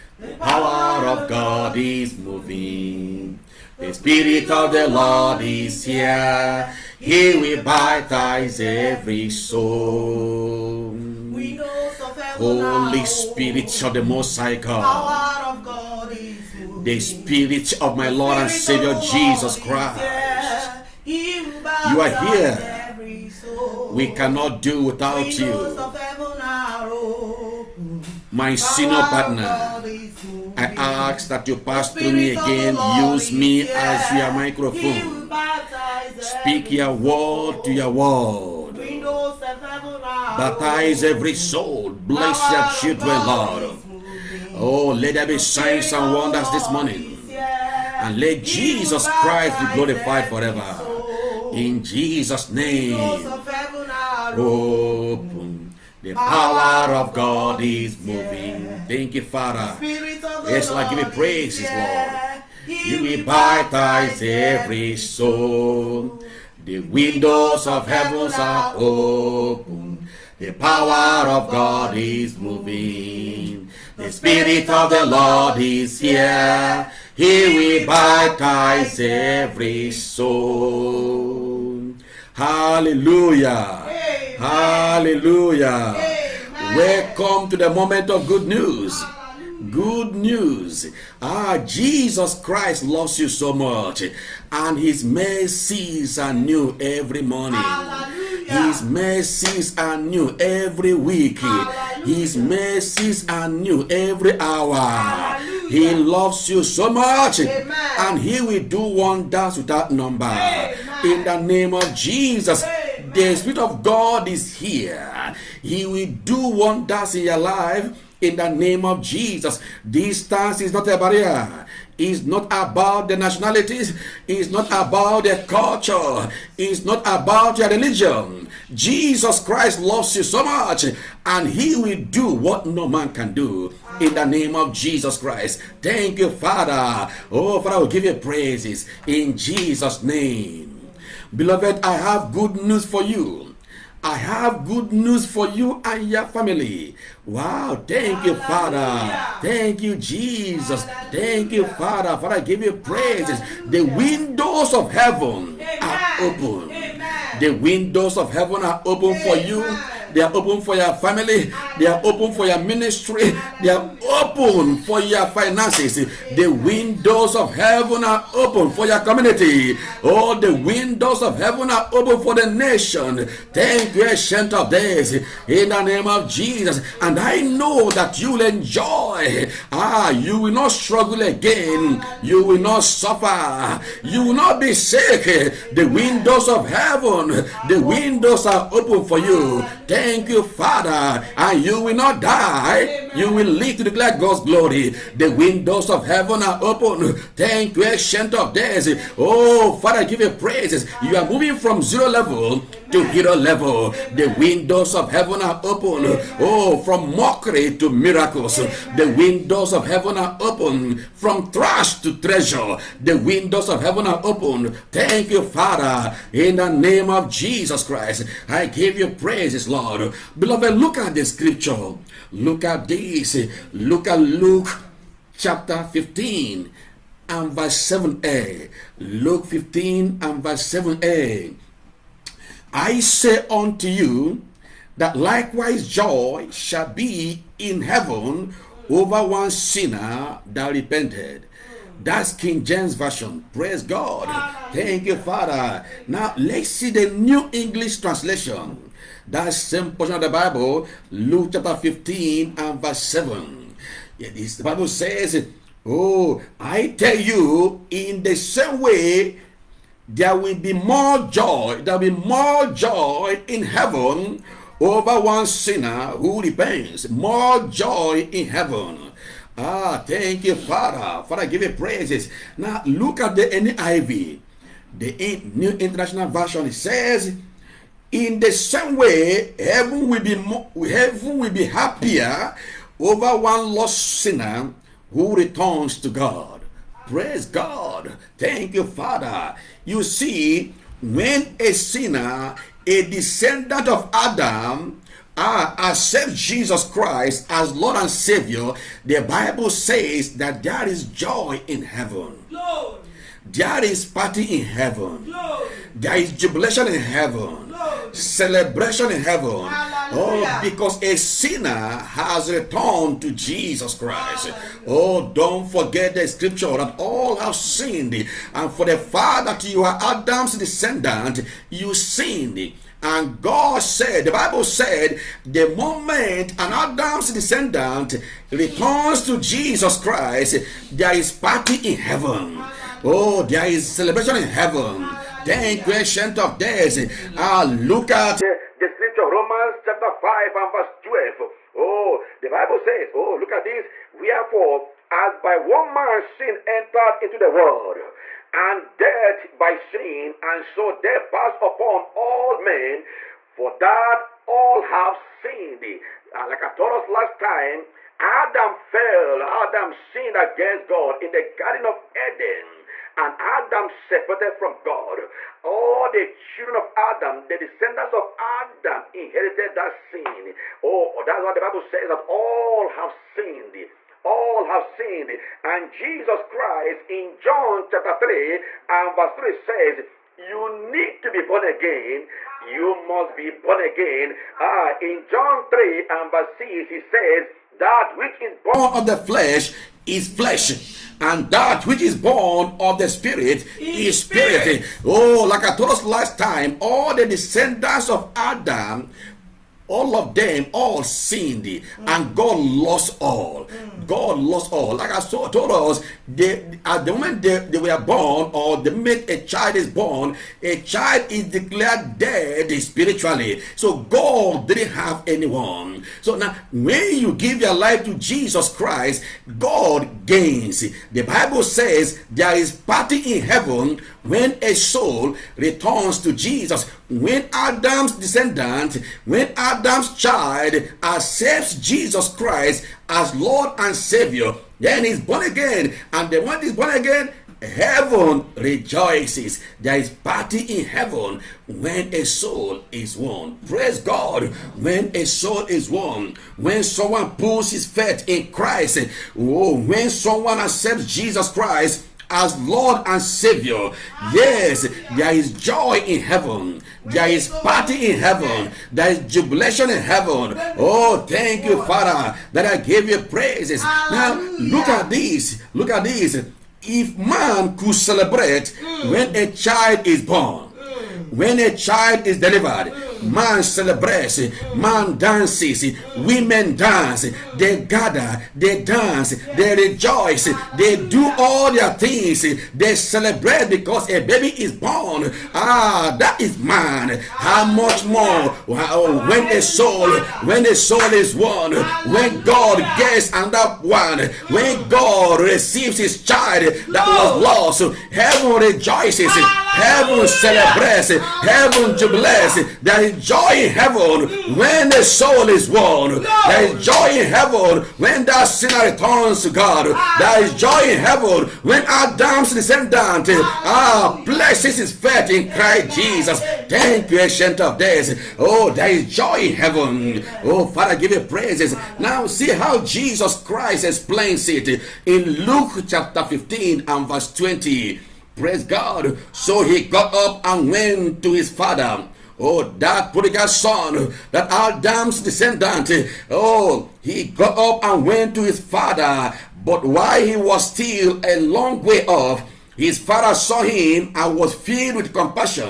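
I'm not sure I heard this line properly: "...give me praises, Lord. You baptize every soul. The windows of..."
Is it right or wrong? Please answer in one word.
right.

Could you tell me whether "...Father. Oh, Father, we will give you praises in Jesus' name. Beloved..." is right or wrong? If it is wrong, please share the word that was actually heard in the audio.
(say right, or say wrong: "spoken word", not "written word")
right.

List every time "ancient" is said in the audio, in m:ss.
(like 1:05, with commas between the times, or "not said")
2:54, 3:17, 8:37.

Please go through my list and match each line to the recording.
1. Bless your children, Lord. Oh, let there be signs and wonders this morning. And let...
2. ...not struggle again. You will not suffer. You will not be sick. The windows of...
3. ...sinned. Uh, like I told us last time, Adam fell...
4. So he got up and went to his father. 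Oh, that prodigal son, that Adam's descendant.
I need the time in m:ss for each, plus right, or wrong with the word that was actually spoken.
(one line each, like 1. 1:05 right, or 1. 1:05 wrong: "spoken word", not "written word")
1. 0:41 right
2. 3:00 right
3. 5:55 right
4. 8:49 right.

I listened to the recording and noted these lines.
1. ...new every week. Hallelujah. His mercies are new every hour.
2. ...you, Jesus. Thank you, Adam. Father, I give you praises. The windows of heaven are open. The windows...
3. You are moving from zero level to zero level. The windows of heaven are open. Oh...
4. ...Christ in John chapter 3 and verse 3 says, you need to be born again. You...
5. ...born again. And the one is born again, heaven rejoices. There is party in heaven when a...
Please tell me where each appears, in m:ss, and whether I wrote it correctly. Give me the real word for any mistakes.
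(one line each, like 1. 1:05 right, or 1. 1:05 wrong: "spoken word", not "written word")
1. 1:39 right
2. 2:29 wrong: "Father", not "Adam"
3. 3:21 right
4. 6:16 right
5. 7:15 right.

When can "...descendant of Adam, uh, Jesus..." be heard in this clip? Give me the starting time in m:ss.
4:53.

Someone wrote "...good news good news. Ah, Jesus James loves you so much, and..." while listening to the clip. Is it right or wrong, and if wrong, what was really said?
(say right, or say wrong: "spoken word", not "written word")
wrong: "Christ", not "James".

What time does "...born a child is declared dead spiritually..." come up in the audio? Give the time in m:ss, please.
6:49.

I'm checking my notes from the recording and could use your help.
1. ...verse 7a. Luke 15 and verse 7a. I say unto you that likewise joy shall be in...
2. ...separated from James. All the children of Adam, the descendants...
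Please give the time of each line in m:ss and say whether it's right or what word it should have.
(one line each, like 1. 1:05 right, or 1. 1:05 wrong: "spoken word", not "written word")
1. 3:47 right
2. 6:03 wrong: "God", not "James".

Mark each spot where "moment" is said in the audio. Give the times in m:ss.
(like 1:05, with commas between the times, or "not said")
1:27, 5:25, 6:47.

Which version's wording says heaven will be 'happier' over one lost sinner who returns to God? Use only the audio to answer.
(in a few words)
New International Version.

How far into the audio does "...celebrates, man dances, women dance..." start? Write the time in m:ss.
7:53.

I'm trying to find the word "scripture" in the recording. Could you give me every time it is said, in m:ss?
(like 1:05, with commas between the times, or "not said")
3:41, 5:16, 5:38.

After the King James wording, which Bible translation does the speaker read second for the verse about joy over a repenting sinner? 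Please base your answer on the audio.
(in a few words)
New English Translation.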